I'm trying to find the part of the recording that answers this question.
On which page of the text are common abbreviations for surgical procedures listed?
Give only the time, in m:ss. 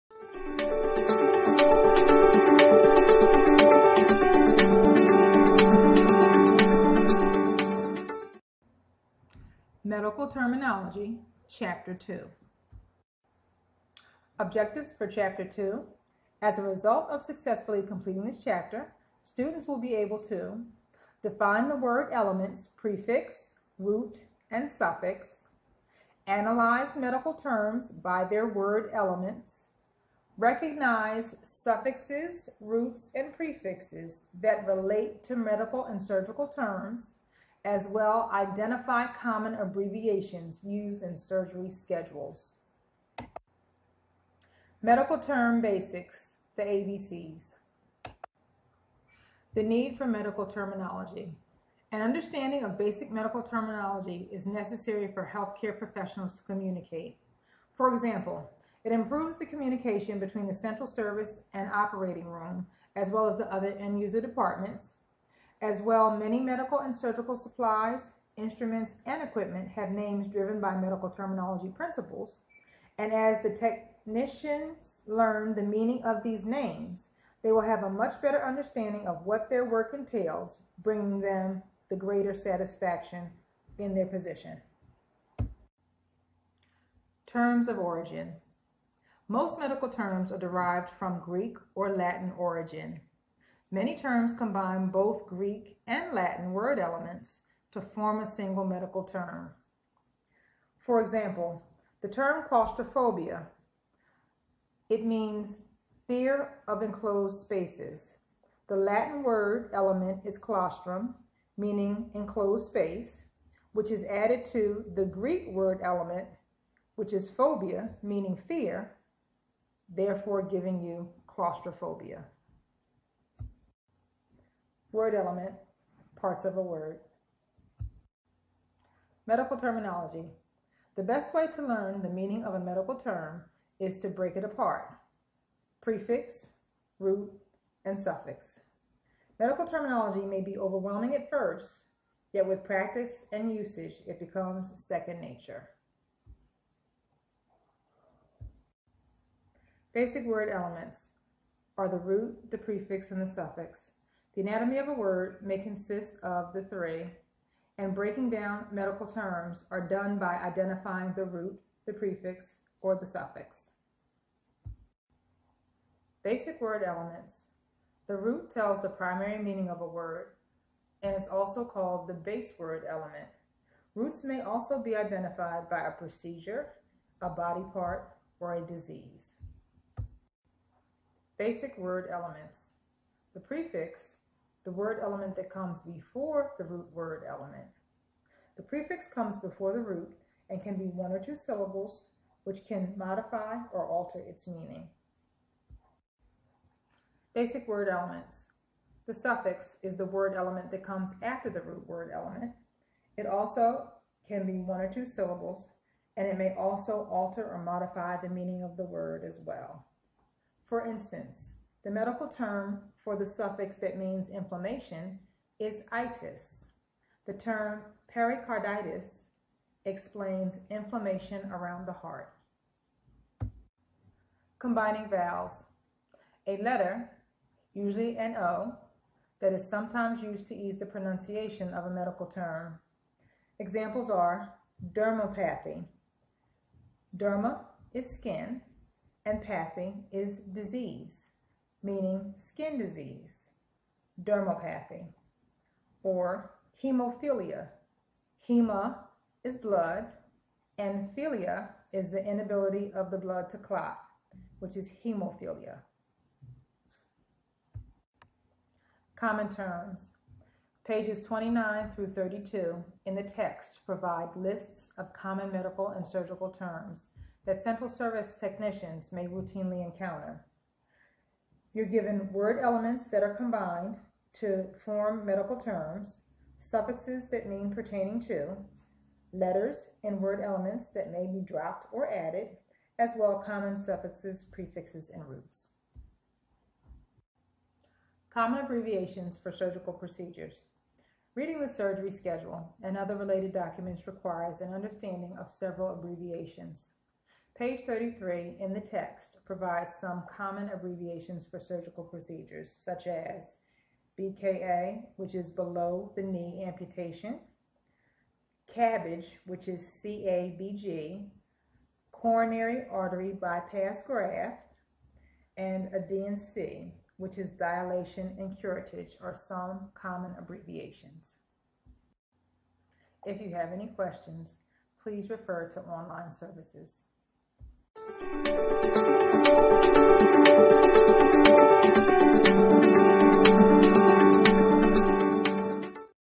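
4:57.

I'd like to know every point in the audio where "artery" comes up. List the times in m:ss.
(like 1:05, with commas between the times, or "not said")
5:12.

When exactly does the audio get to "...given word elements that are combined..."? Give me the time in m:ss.
4:31.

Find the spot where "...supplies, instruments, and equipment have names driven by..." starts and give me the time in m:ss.
1:07.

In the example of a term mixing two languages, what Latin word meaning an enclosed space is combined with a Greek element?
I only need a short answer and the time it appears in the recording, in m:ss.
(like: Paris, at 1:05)
claustrum, at 1:50.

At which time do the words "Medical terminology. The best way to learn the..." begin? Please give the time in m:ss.
2:09.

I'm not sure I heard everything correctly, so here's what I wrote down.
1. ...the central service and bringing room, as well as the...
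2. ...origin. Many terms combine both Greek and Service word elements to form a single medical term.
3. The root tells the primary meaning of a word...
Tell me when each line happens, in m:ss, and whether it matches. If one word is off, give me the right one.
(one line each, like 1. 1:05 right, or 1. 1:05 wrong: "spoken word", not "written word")
1. 1:00 wrong: "operating", not "bringing"
2. 1:32 wrong: "Latin", not "Service"
3. 2:48 right.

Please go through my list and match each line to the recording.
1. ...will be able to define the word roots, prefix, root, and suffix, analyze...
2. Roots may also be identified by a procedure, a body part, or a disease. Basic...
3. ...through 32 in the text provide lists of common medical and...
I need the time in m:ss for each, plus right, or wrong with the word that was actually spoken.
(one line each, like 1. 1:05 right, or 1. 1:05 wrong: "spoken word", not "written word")
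1. 0:19 wrong: "elements", not "roots"
2. 2:53 right
3. 4:21 right.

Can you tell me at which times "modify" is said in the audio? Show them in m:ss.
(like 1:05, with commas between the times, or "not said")
3:12, 3:27.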